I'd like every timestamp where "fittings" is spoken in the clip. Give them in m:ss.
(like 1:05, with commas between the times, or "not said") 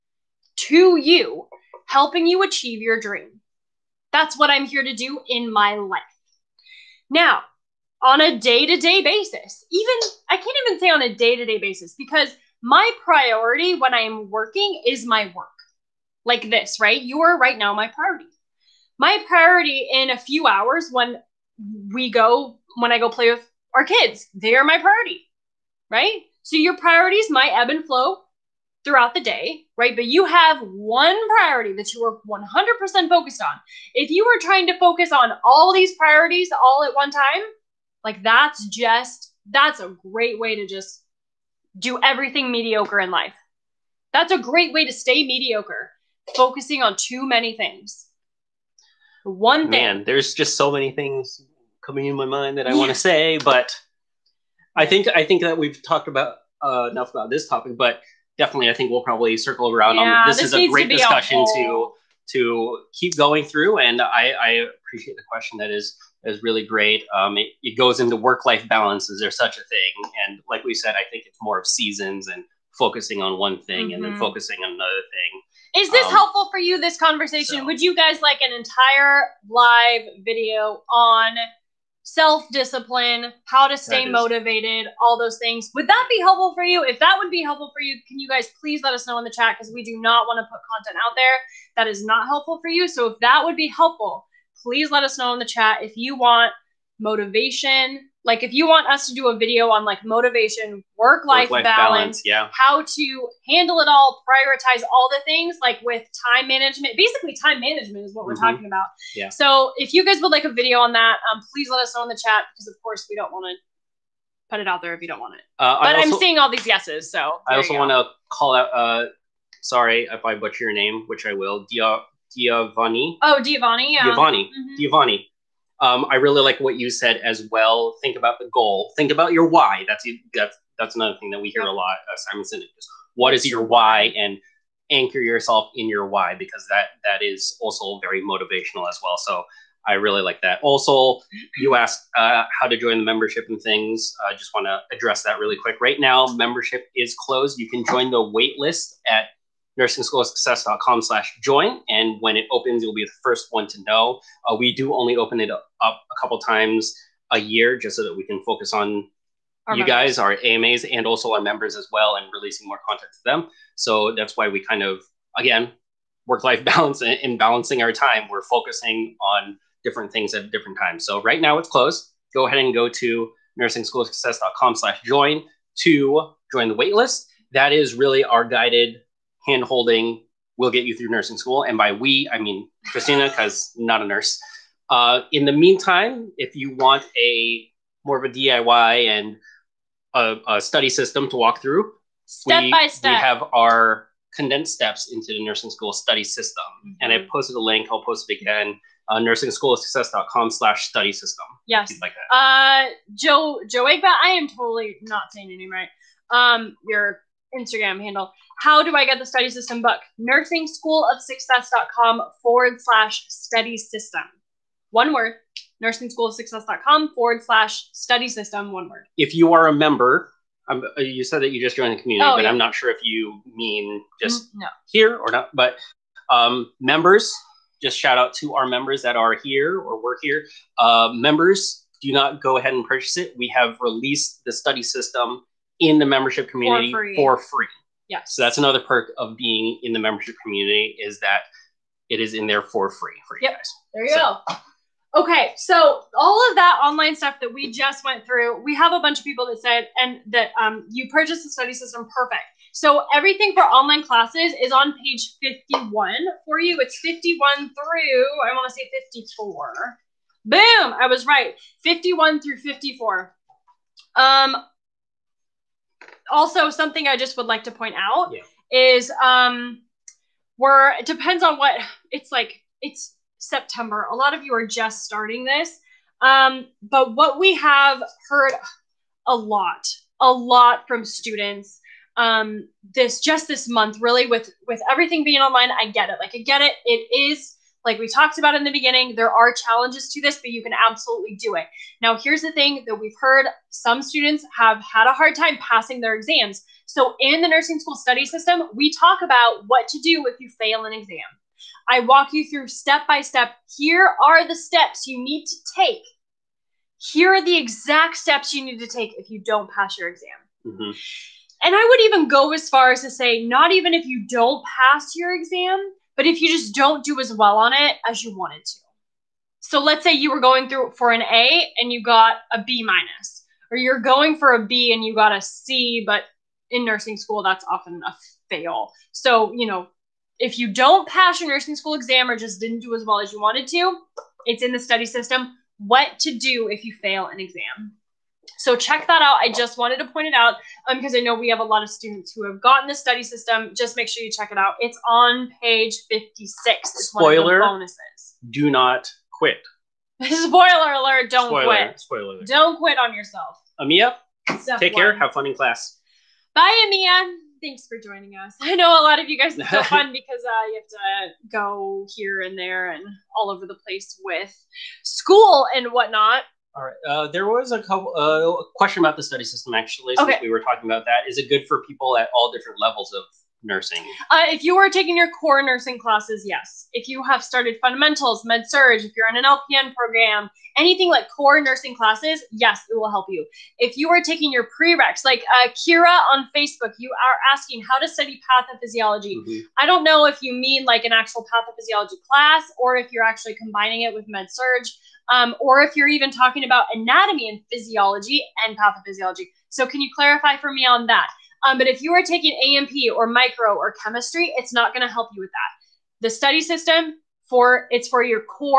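not said.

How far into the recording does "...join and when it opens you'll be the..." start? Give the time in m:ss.
2:31.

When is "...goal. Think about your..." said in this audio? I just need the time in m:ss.
2:08.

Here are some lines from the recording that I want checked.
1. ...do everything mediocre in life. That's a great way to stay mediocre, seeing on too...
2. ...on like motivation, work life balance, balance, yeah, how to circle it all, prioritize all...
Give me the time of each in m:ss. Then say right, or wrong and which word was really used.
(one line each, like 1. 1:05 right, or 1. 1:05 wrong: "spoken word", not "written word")
1. 0:41 wrong: "focusing", not "seeing"
2. 1:39 wrong: "handle", not "circle".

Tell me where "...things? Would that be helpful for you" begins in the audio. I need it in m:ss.
1:25.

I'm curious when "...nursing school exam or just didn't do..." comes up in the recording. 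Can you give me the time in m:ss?
5:31.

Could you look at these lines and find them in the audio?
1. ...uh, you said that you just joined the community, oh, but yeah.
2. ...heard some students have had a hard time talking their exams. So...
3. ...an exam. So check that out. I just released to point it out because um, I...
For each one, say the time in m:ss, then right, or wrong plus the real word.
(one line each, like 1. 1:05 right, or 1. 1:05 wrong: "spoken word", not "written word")
1. 3:40 right
2. 4:53 wrong: "passing", not "talking"
3. 5:37 wrong: "wanted", not "released".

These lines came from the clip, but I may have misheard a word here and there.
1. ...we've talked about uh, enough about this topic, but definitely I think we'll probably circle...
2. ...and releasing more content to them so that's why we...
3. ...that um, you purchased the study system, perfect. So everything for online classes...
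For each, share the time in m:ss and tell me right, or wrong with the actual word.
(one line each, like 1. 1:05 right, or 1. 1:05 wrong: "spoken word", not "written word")
1. 0:55 right
2. 2:42 right
3. 4:10 right.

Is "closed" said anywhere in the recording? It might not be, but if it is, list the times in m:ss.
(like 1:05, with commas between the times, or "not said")
2:27, 2:51.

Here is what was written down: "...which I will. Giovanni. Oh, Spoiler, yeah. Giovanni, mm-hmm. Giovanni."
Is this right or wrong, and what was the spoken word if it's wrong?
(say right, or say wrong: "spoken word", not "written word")
wrong: "Giovanni", not "Spoiler".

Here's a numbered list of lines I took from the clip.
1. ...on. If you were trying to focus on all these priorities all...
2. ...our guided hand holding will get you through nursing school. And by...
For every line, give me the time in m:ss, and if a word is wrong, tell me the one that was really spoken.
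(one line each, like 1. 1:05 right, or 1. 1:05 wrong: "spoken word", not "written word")
1. 0:33 right
2. 2:58 right.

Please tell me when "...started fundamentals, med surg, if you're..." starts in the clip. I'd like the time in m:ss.
6:17.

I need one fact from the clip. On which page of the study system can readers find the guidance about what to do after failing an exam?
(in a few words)
56.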